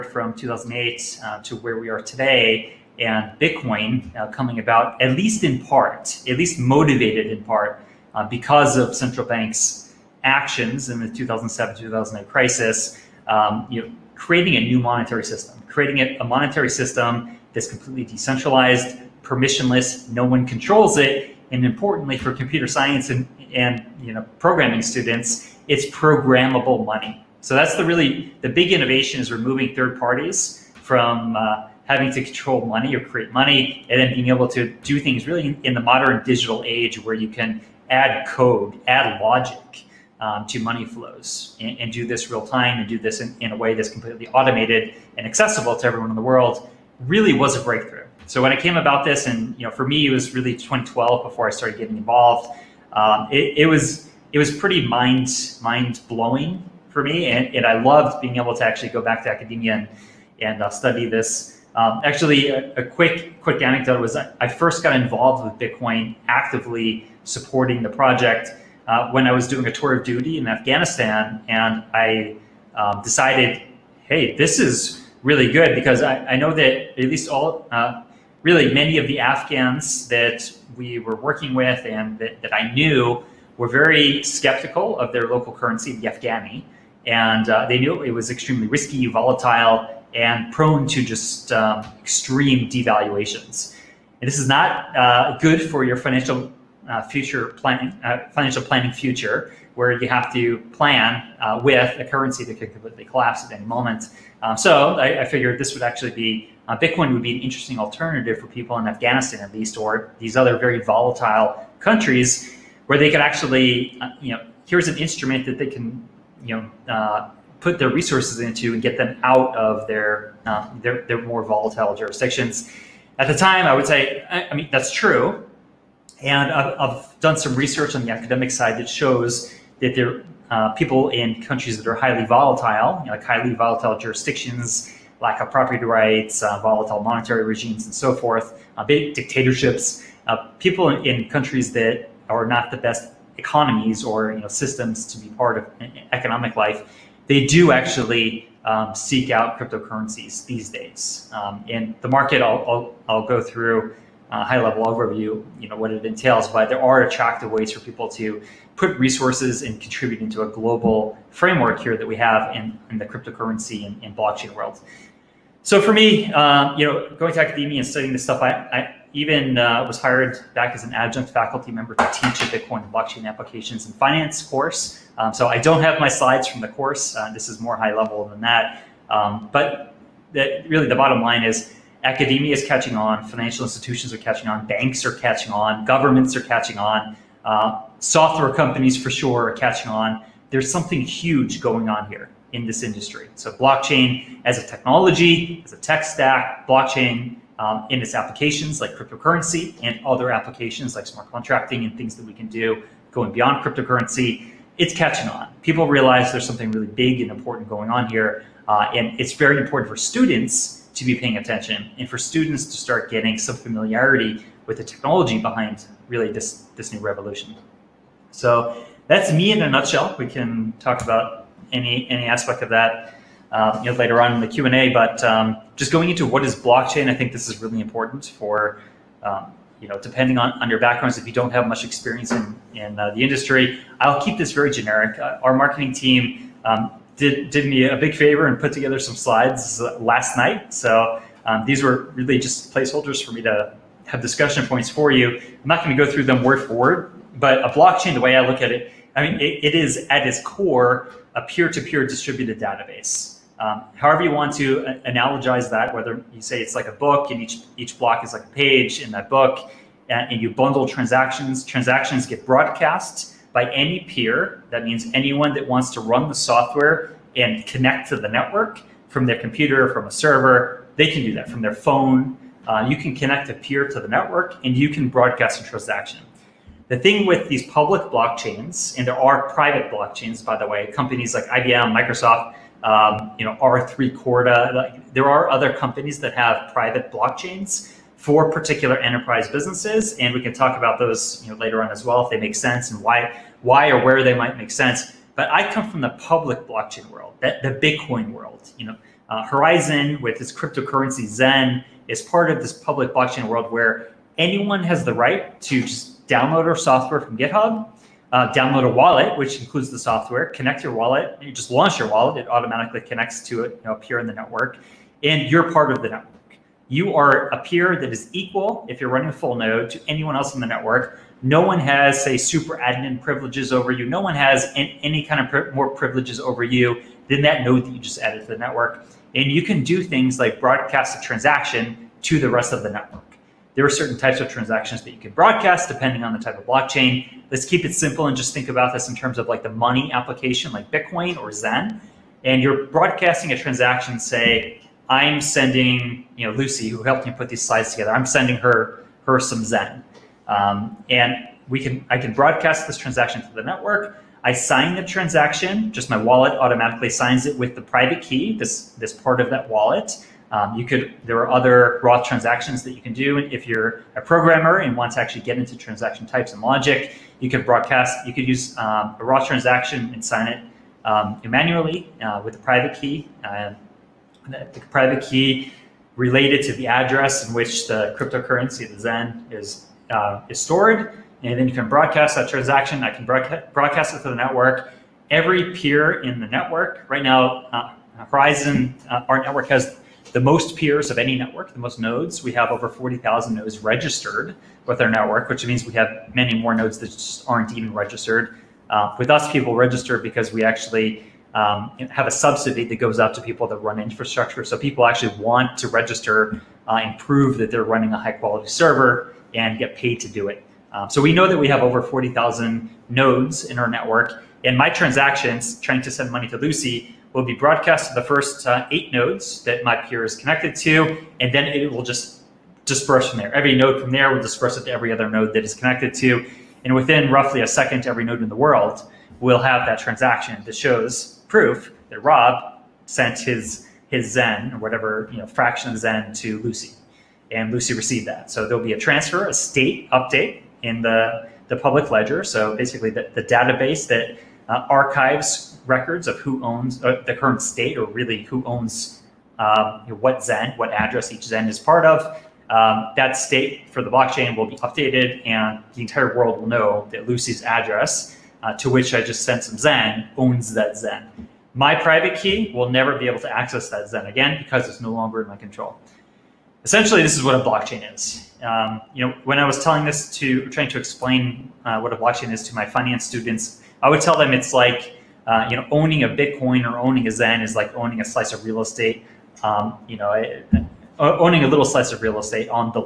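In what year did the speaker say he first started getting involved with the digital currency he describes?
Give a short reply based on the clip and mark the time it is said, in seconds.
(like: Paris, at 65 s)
2012, at 50 s.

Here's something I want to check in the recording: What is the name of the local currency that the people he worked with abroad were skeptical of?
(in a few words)
Afghani.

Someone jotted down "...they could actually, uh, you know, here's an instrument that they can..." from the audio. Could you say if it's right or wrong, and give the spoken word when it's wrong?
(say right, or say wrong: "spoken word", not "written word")
right.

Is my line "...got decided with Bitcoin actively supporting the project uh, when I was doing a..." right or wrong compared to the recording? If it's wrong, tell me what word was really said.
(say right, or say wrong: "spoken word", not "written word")
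wrong: "involved", not "decided".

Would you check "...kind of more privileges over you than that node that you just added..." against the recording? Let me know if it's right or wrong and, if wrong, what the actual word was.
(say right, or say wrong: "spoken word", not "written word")
right.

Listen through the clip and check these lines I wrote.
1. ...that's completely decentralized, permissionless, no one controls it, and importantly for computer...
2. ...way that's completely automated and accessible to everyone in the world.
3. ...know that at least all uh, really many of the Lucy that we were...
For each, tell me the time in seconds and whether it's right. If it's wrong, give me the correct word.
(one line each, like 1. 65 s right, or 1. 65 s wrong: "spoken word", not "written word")
1. 17 s right
2. 43 s right
3. 76 s wrong: "Afghans", not "Lucy".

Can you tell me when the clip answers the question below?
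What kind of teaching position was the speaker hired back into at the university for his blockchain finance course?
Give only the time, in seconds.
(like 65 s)
170 s.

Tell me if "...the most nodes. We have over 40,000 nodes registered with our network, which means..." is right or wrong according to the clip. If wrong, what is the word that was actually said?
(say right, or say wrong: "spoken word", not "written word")
right.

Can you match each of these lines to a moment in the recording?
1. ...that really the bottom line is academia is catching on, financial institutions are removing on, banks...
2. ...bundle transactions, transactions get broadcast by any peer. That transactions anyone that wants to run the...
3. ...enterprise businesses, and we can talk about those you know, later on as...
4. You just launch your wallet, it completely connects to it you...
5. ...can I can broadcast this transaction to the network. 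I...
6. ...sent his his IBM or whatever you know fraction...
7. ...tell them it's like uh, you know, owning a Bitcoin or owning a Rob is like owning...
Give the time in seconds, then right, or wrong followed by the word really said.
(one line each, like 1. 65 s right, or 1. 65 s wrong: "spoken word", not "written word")
1. 180 s wrong: "catching", not "removing"
2. 260 s wrong: "means", not "transactions"
3. 288 s right
4. 311 s wrong: "automatically", not "completely"
5. 351 s right
6. 433 s wrong: "Zen", not "IBM"
7. 474 s wrong: "Zen", not "Rob".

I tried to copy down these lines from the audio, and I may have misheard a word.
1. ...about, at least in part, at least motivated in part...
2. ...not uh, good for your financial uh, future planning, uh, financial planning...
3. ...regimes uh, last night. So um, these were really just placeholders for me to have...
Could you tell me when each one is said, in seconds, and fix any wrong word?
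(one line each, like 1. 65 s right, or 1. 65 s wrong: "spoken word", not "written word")
1. 4 s right
2. 94 s right
3. 239 s wrong: "slides", not "regimes".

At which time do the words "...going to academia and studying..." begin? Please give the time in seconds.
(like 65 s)
167 s.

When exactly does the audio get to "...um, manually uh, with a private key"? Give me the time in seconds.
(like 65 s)
371 s.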